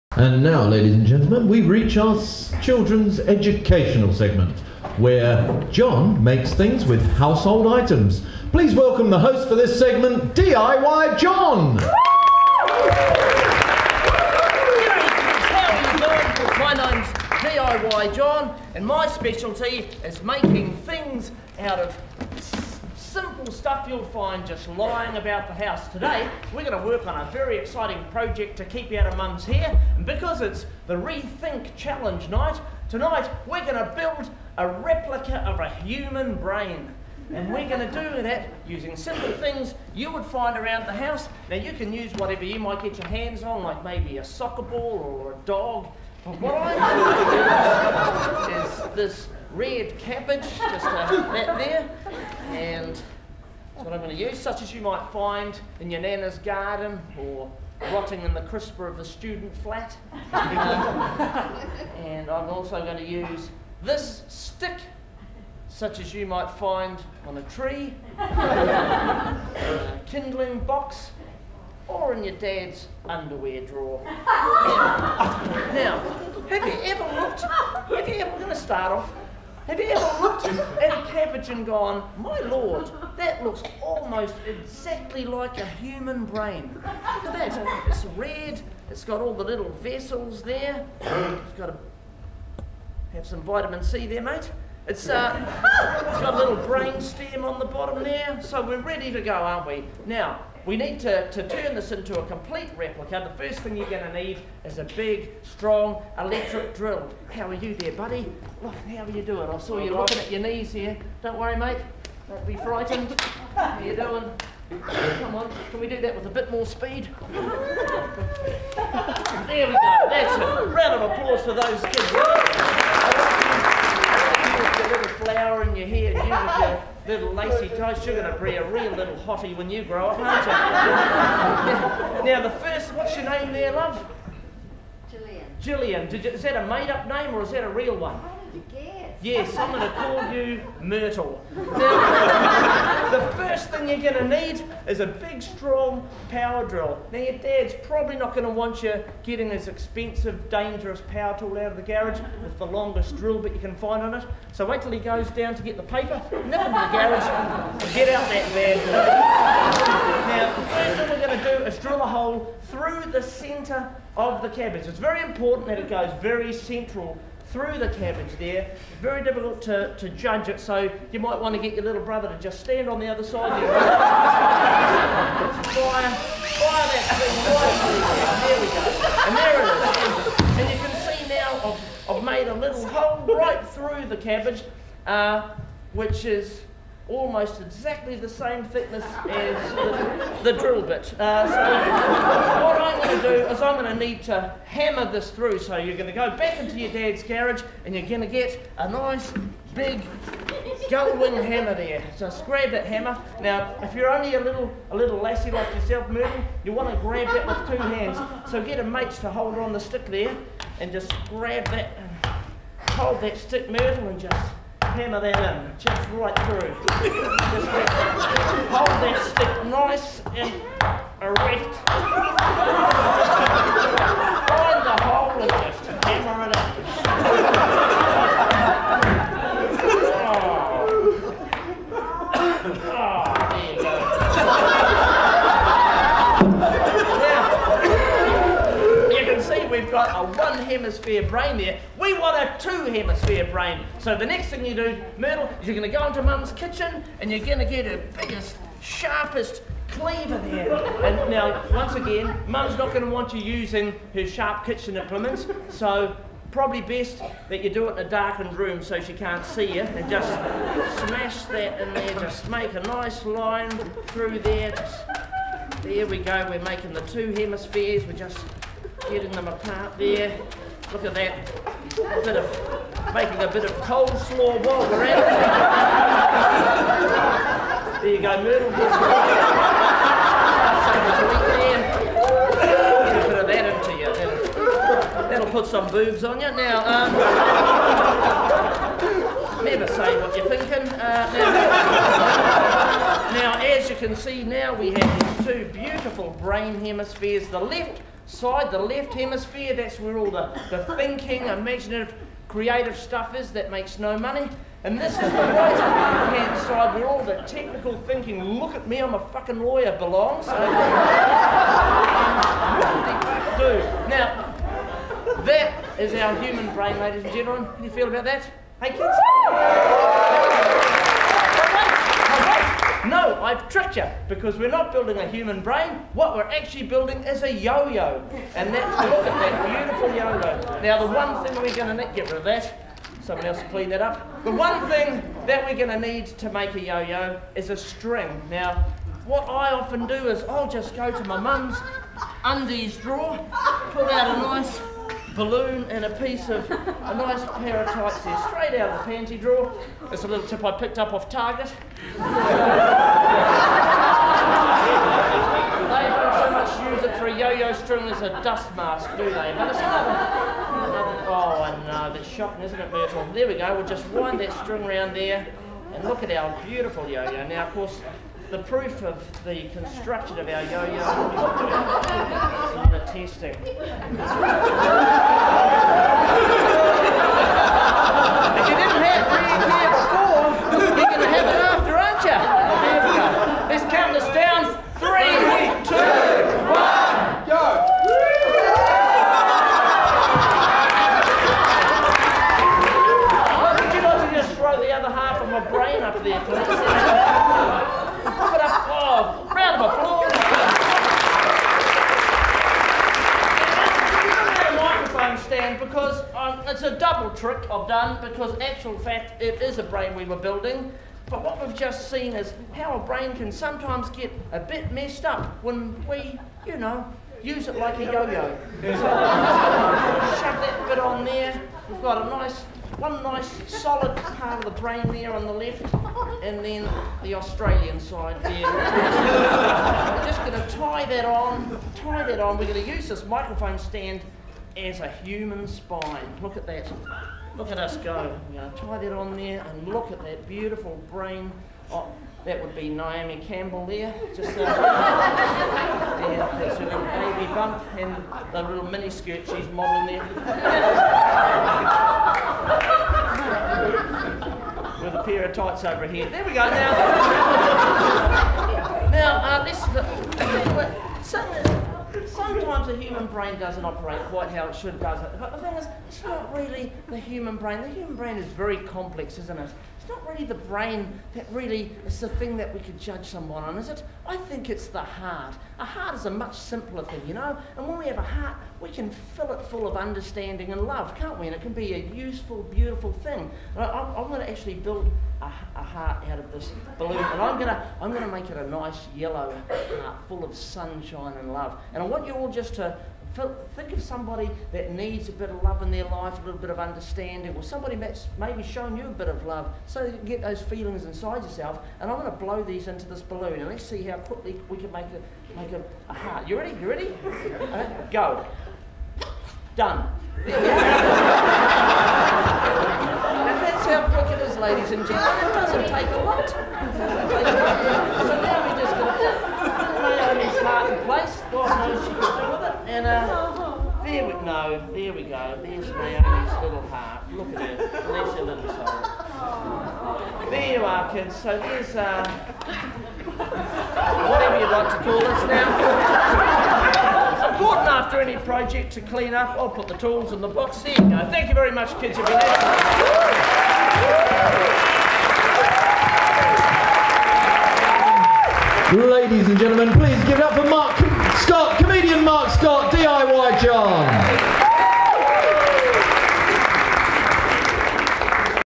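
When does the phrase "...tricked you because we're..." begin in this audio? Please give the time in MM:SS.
05:23.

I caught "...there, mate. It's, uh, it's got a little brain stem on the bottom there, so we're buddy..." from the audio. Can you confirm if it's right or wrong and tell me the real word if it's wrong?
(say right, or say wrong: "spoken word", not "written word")
wrong: "ready", not "buddy".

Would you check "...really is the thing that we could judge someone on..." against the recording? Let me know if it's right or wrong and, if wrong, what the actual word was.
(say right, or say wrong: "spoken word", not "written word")
right.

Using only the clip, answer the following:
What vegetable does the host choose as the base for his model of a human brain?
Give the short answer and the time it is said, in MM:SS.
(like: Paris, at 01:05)
Red cabbage, at 00:49.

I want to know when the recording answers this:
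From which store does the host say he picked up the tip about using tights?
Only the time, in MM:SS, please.
05:51.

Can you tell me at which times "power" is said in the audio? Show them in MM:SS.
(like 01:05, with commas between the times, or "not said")
02:26, 02:31.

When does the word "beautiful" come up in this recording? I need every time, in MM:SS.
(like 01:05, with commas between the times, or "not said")
04:55, 05:29, 06:06, 07:20, 08:02.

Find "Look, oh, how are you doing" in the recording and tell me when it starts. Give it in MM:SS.
01:48.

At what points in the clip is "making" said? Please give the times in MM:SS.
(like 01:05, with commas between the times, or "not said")
00:20, 04:26, 04:33.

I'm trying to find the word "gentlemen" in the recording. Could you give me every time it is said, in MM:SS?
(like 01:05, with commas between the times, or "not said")
00:01, 05:17, 08:35, 09:09.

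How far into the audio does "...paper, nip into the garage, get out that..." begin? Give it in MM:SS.
02:35.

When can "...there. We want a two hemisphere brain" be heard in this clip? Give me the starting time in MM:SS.
04:01.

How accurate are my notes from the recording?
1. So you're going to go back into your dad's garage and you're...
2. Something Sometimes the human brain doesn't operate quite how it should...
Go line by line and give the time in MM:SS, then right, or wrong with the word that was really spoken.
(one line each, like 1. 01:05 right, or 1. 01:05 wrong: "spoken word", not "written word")
1. 03:15 right
2. 07:41 right.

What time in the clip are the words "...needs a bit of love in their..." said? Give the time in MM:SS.
08:14.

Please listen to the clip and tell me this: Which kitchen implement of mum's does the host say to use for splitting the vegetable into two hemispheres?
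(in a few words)
Cleaver.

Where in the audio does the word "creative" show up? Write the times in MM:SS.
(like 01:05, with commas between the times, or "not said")
05:02.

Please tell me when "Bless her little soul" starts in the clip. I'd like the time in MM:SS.
08:48.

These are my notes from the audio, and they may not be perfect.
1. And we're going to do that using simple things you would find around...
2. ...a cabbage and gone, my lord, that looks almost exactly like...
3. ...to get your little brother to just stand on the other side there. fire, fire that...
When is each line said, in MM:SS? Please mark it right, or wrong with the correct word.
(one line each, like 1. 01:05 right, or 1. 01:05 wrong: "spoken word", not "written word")
1. 00:37 right
2. 01:20 right
3. 02:51 right.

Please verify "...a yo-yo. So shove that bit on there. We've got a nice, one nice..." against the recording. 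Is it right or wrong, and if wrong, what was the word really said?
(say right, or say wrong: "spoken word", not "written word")
right.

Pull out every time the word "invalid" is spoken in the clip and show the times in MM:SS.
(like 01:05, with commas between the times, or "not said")
not said.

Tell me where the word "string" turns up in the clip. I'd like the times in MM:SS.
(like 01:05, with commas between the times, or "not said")
05:37, 05:57, 06:04.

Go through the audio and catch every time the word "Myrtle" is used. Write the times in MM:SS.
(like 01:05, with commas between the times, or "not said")
02:20, 03:26, 03:33, 04:05, 04:38, 06:02.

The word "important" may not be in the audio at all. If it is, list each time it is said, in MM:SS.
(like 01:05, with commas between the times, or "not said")
02:45, 08:57.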